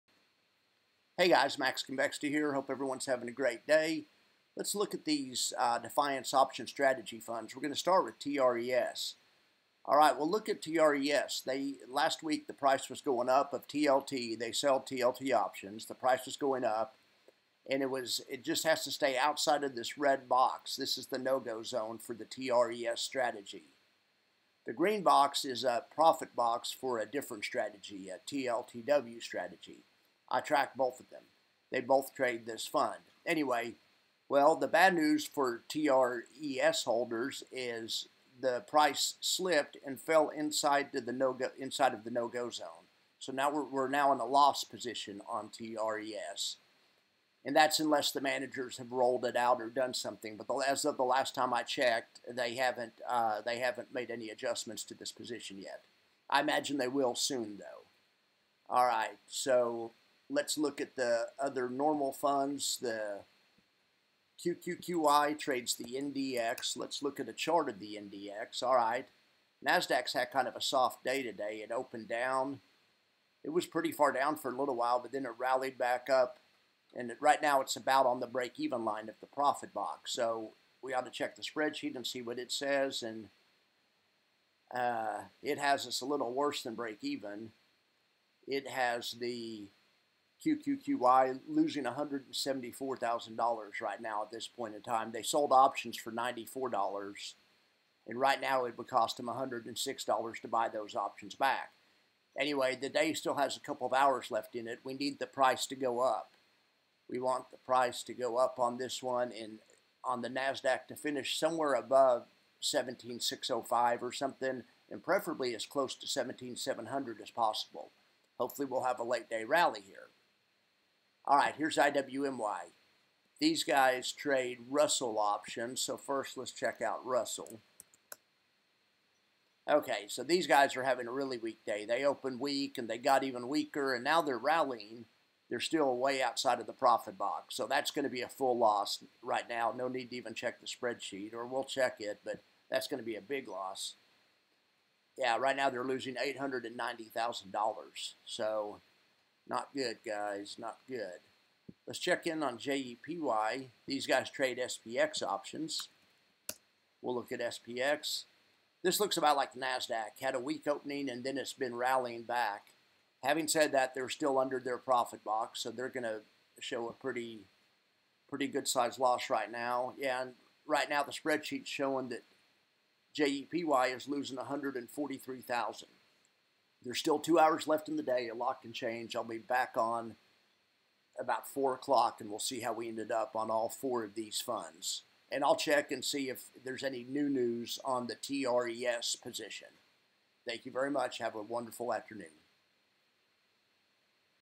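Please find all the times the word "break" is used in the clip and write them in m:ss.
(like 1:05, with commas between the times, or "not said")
1:18, 1:26.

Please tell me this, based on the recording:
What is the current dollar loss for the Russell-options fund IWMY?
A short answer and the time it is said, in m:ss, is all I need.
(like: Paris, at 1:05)
$890,000, at 2:26.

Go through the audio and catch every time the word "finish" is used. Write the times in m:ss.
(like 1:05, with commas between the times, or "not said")
1:50.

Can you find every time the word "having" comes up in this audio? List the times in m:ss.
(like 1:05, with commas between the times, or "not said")
0:03, 2:10, 2:43.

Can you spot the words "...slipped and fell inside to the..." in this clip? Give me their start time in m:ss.
0:39.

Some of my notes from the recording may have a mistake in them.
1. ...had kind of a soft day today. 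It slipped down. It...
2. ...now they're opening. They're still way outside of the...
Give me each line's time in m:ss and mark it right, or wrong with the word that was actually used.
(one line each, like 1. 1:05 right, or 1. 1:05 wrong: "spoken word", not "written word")
1. 1:10 wrong: "opened", not "slipped"
2. 2:14 wrong: "rallying", not "opening".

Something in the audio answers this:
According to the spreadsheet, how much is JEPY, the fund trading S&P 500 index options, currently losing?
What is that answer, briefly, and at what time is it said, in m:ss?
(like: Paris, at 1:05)
143,000, at 2:54.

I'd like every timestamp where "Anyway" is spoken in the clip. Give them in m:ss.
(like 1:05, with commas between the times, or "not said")
0:33, 1:42.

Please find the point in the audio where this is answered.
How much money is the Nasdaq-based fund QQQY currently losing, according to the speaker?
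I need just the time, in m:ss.
1:31.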